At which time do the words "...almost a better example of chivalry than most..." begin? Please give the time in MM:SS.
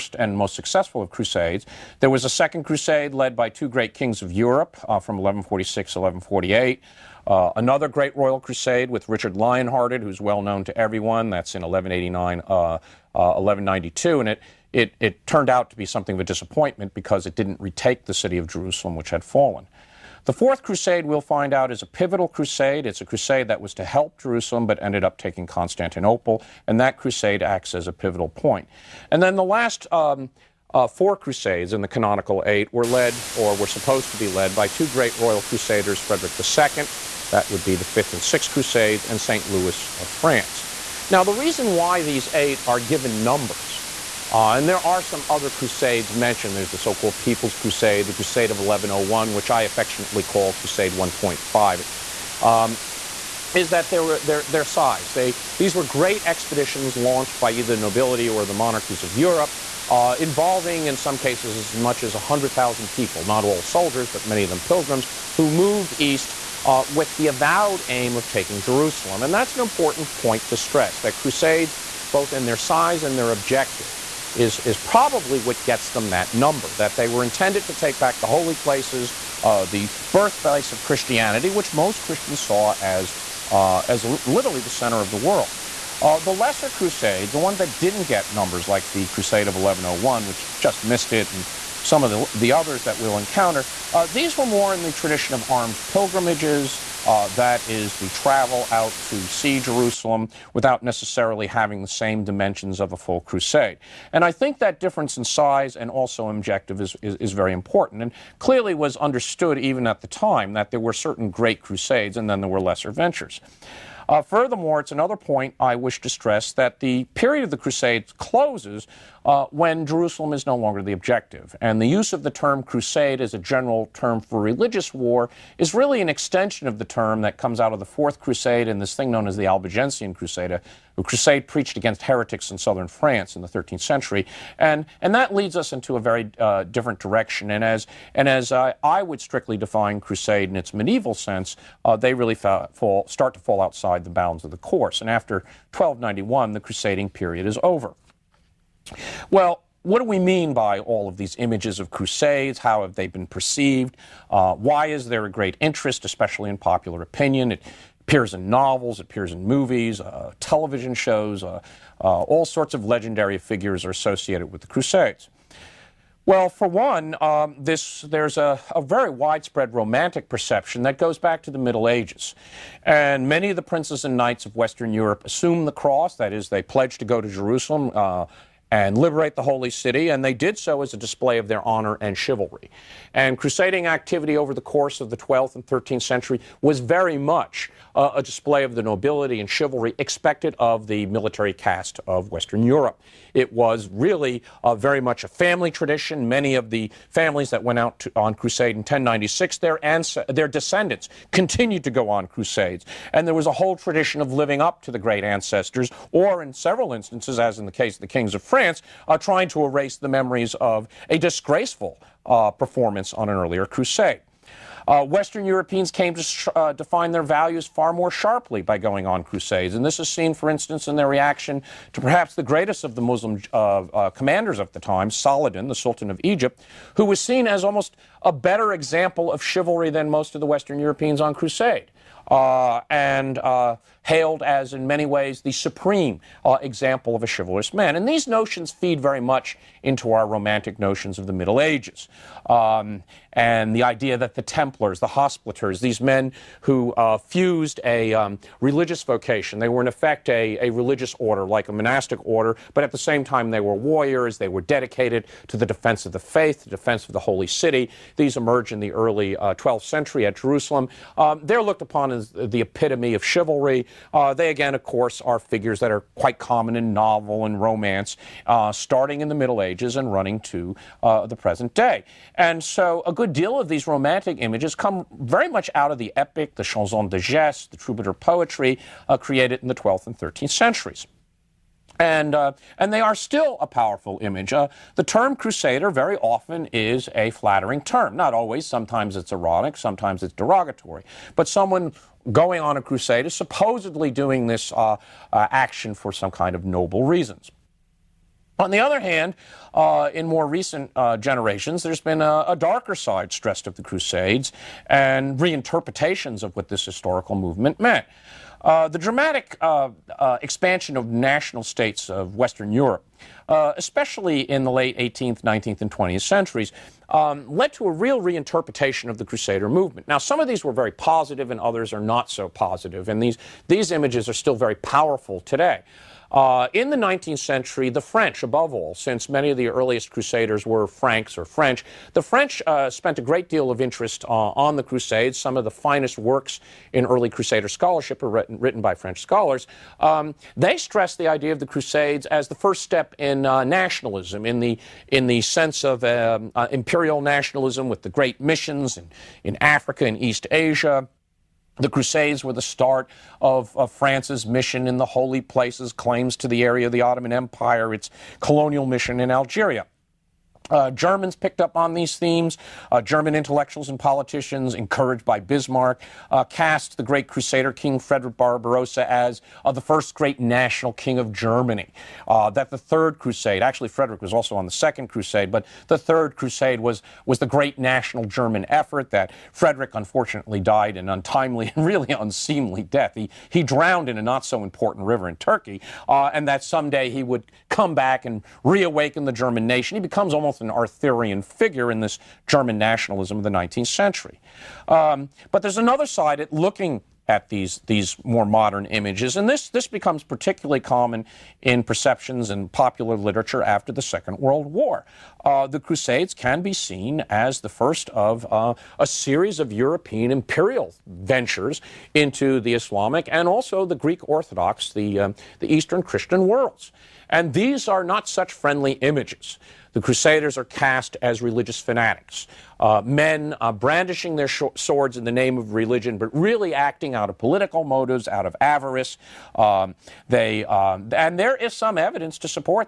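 03:47.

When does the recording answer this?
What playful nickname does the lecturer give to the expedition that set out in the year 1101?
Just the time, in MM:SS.
00:50.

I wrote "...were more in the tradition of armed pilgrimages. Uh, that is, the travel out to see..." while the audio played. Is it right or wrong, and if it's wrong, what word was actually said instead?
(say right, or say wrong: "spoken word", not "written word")
right.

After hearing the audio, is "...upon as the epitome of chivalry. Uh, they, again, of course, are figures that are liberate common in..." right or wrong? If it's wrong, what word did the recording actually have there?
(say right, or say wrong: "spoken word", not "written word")
wrong: "quite", not "liberate".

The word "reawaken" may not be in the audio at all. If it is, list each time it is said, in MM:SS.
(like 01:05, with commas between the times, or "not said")
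06:28.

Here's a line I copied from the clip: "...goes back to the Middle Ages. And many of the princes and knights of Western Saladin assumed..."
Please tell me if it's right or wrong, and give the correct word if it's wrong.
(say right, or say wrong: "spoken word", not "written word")
wrong: "Europe", not "Saladin".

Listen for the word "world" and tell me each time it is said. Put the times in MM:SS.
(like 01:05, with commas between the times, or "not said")
01:25, 06:44, 06:56.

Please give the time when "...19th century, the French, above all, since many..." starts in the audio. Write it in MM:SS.
05:26.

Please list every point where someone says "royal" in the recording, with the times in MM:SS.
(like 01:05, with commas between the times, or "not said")
00:08, 00:35.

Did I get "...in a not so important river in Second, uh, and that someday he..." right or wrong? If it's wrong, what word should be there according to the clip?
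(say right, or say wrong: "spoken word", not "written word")
wrong: "Turkey", not "Second".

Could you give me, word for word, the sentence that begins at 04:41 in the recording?
And, uh, and they are still a powerful image.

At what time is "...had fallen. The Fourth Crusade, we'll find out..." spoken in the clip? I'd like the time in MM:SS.
00:19.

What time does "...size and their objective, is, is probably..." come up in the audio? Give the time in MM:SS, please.
01:12.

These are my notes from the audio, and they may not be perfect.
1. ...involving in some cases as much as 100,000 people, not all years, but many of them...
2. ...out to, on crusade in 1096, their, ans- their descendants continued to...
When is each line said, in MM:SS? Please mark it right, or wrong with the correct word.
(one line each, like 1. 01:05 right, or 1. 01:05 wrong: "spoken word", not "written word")
1. 01:00 wrong: "soldiers", not "years"
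2. 03:17 right.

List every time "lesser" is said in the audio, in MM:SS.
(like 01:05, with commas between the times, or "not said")
01:26, 01:52.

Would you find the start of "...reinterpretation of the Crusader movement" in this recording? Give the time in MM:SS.
05:18.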